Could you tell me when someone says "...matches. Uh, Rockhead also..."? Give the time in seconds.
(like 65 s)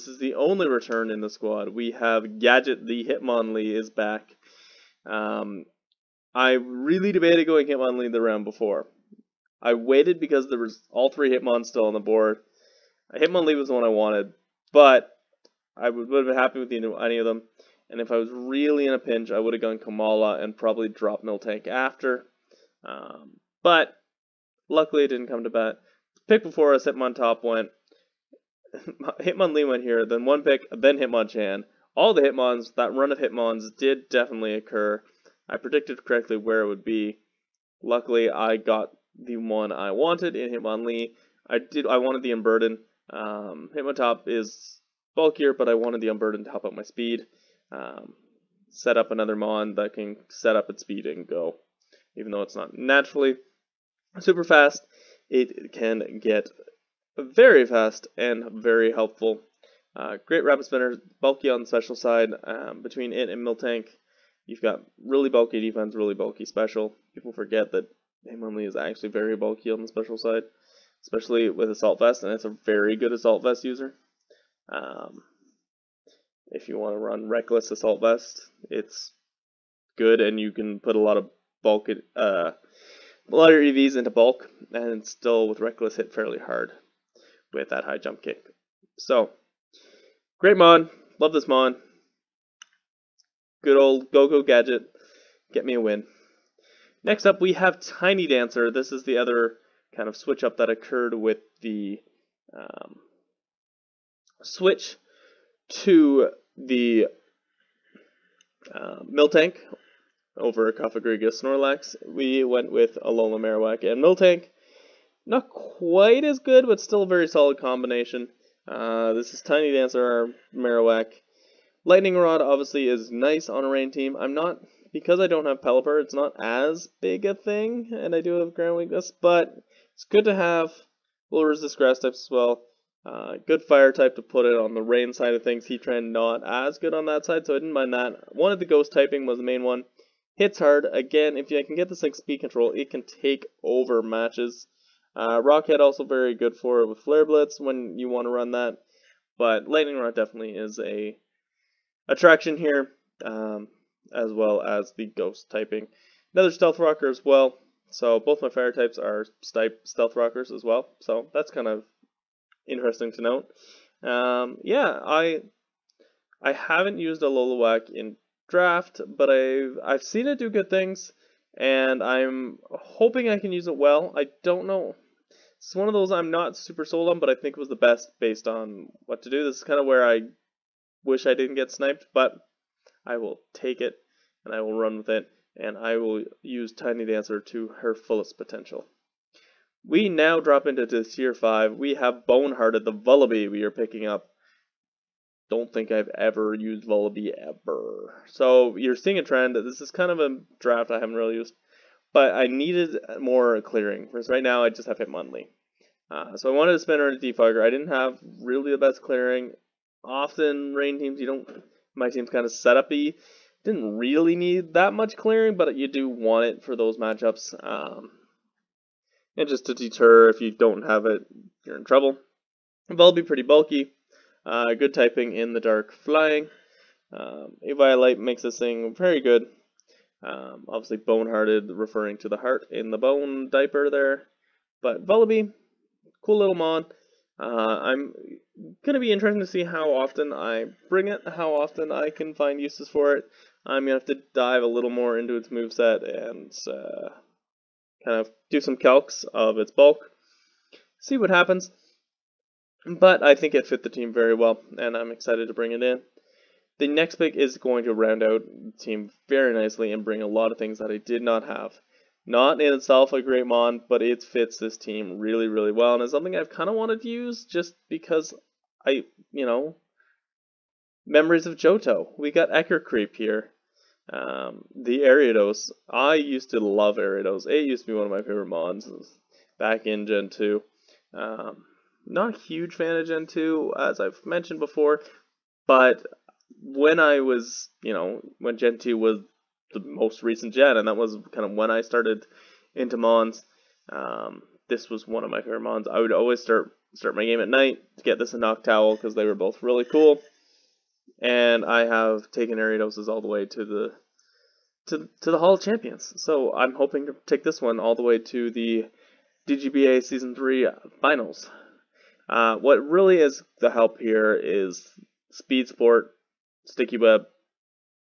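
144 s.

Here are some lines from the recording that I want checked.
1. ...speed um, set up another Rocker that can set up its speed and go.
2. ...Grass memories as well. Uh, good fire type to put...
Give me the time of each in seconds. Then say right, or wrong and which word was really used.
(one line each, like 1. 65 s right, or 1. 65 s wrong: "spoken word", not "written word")
1. 46 s wrong: "Mon", not "Rocker"
2. 131 s wrong: "types", not "memories".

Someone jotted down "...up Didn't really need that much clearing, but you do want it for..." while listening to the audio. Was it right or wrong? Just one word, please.
right.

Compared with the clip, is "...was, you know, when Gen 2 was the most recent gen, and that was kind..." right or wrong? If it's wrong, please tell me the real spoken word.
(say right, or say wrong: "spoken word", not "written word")
right.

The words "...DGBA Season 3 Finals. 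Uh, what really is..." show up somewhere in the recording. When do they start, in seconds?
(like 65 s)
309 s.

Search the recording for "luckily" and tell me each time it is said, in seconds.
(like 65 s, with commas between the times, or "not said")
24 s, 37 s.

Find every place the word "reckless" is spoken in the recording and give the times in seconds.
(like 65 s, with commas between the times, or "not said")
77 s, 85 s.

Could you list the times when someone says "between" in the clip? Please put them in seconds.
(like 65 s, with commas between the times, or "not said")
62 s.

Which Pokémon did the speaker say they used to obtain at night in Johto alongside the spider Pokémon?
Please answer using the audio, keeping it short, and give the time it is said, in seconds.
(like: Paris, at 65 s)
Noctowl, at 298 s.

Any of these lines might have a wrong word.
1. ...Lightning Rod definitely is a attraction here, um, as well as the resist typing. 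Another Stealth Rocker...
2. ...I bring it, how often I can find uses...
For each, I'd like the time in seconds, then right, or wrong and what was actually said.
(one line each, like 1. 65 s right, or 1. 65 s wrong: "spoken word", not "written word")
1. 149 s wrong: "ghost", not "resist"
2. 240 s right.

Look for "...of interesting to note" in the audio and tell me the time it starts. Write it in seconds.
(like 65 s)
161 s.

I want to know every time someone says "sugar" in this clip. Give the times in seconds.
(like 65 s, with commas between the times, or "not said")
not said.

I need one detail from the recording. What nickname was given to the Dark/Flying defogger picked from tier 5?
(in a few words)
Bonehearted.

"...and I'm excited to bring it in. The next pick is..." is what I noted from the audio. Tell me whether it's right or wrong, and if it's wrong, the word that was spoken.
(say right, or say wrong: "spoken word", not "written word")
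right.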